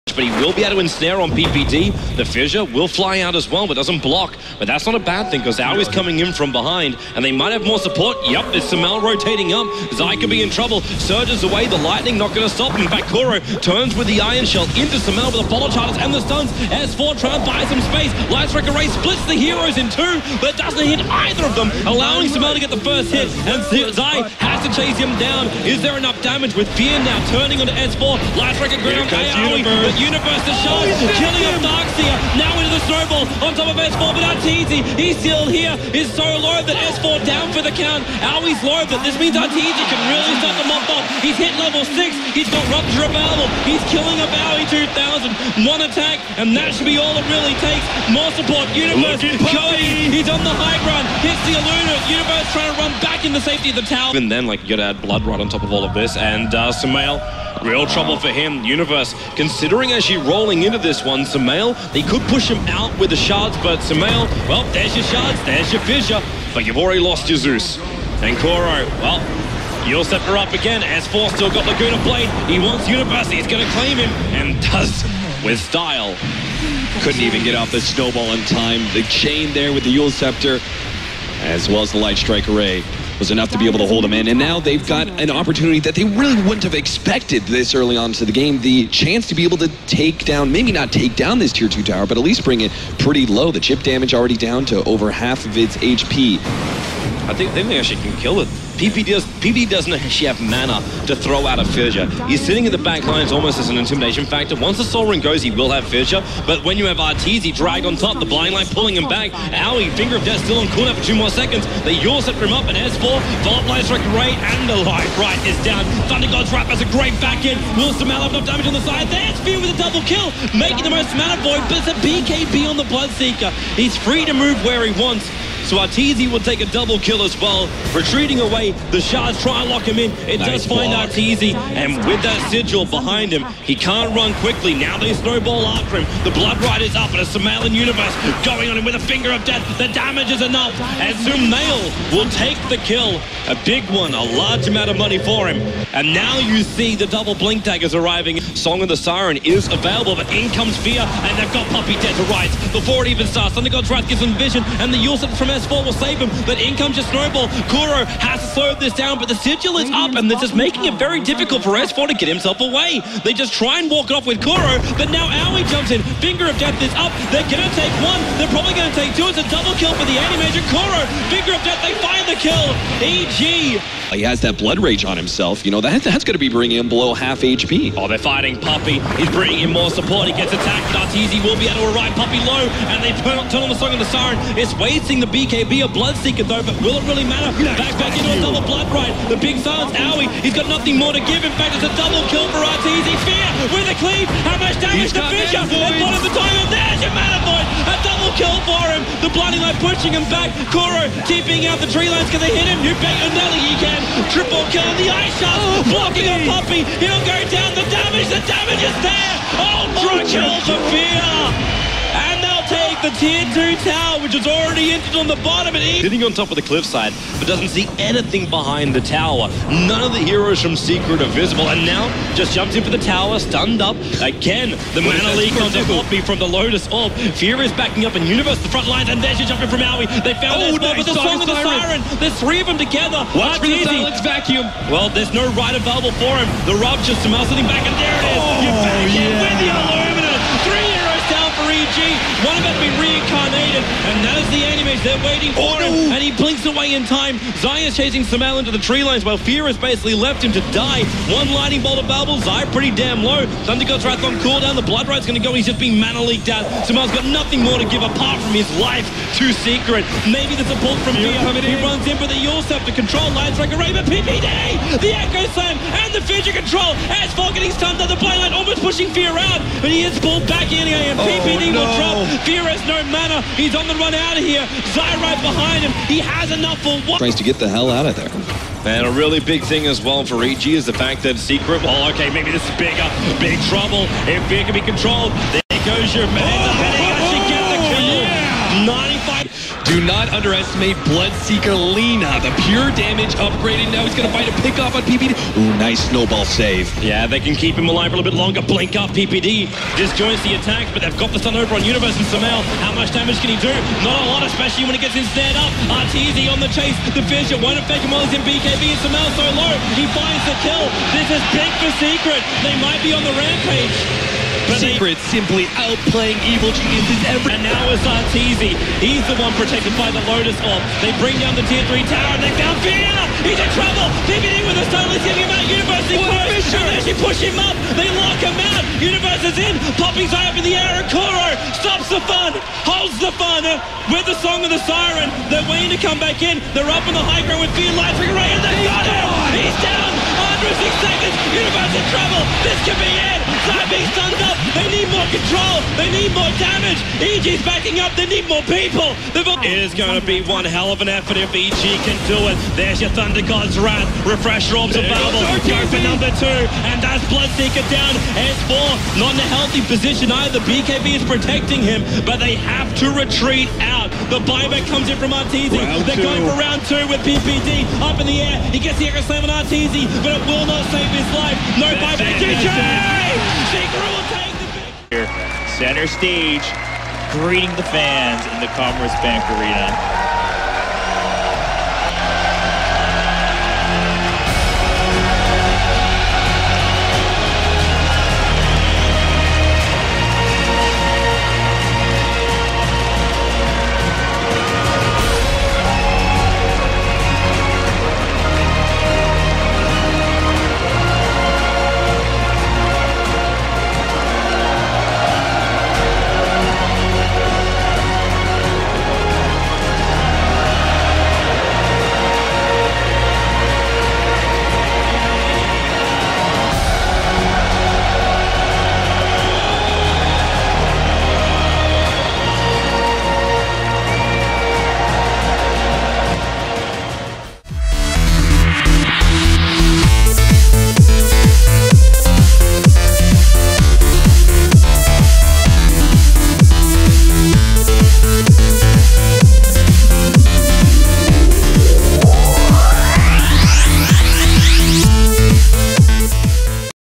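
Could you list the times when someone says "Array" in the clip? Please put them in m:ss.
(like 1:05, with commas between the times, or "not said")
0:18, 0:28, 1:22.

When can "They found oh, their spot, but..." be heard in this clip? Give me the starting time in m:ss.
3:50.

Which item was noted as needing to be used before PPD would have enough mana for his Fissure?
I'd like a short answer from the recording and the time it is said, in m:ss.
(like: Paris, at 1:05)
Soul Ring, at 1:44.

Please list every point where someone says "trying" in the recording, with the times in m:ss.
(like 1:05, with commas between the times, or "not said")
0:17, 0:52.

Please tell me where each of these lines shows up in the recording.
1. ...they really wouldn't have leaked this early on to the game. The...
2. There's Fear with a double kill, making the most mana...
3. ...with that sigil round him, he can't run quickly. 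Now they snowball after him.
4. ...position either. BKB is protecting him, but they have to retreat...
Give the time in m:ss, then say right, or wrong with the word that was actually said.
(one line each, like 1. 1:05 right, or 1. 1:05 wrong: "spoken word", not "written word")
1. 1:25 wrong: "expected", not "leaked"
2. 1:59 right
3. 2:12 wrong: "behind", not "round"
4. 5:59 right.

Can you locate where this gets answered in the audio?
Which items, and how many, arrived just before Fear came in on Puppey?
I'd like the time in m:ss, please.
2:27.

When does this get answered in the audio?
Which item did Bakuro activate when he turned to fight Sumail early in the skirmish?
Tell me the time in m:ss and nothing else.
0:14.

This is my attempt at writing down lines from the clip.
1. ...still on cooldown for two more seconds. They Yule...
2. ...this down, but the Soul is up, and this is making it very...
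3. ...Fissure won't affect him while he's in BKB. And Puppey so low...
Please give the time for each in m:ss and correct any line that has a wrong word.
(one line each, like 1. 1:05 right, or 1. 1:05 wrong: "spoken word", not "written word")
1. 1:50 right
2. 2:38 wrong: "Sigil", not "Soul"
3. 5:07 wrong: "Sumail", not "Puppey".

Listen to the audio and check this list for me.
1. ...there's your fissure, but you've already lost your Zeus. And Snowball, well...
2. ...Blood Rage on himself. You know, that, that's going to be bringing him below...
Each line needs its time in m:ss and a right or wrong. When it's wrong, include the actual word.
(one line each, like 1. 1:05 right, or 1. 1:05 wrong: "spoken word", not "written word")
1. 1:05 wrong: "Kuro", not "Snowball"
2. 2:54 right.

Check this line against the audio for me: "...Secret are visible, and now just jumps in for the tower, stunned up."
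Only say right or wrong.
right.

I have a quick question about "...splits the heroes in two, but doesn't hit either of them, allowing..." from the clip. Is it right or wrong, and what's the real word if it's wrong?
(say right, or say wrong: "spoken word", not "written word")
right.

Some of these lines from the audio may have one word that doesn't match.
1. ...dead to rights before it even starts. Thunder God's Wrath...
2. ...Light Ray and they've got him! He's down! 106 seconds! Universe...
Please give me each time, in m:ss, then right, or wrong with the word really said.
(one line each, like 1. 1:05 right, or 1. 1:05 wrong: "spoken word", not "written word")
1. 2:32 right
2. 5:37 right.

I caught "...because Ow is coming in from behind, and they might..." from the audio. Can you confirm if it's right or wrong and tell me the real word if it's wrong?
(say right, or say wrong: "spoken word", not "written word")
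right.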